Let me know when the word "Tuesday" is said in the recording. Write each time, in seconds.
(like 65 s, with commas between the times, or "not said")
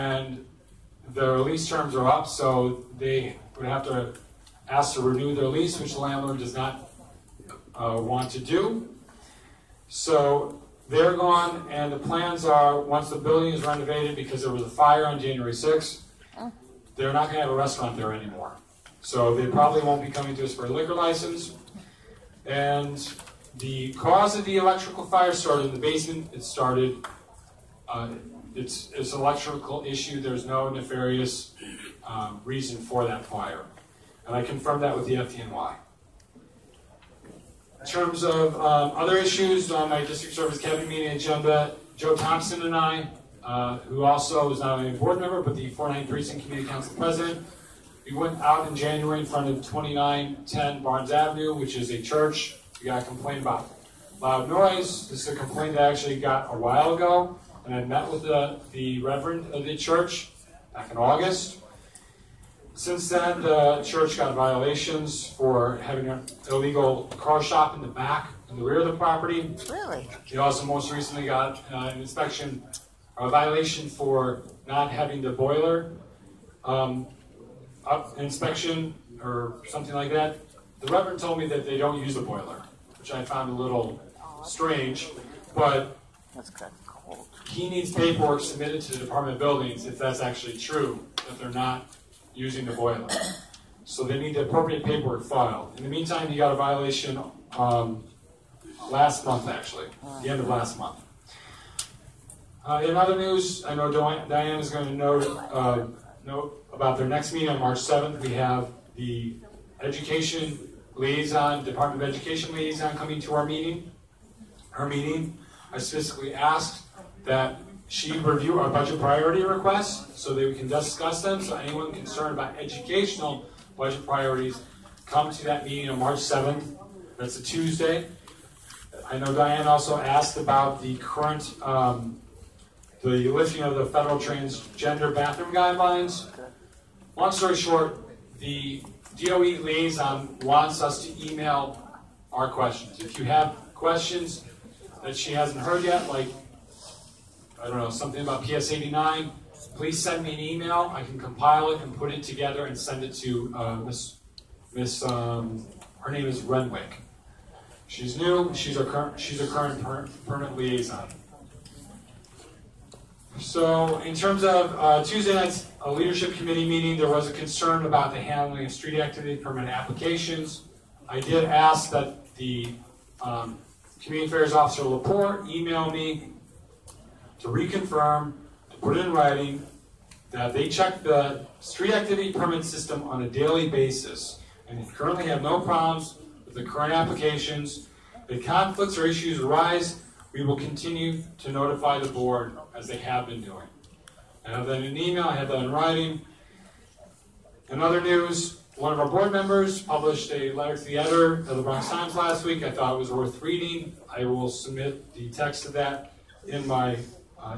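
127 s, 165 s.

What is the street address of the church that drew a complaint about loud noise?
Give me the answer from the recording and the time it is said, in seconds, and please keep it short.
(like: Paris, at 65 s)
2910 Barnes Avenue, at 49 s.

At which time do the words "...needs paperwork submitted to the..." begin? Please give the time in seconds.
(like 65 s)
87 s.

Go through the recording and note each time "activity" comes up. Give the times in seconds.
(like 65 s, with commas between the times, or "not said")
169 s, 181 s.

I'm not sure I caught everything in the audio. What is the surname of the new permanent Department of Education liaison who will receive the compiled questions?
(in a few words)
Renwick.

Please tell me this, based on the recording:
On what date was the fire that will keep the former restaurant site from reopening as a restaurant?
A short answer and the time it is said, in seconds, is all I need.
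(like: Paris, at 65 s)
January 6th, at 15 s.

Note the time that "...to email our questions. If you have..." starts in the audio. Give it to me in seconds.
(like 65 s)
141 s.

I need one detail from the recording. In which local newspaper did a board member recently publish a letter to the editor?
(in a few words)
Bronx Times.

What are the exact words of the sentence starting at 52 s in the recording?
We got a complaint about loud noise.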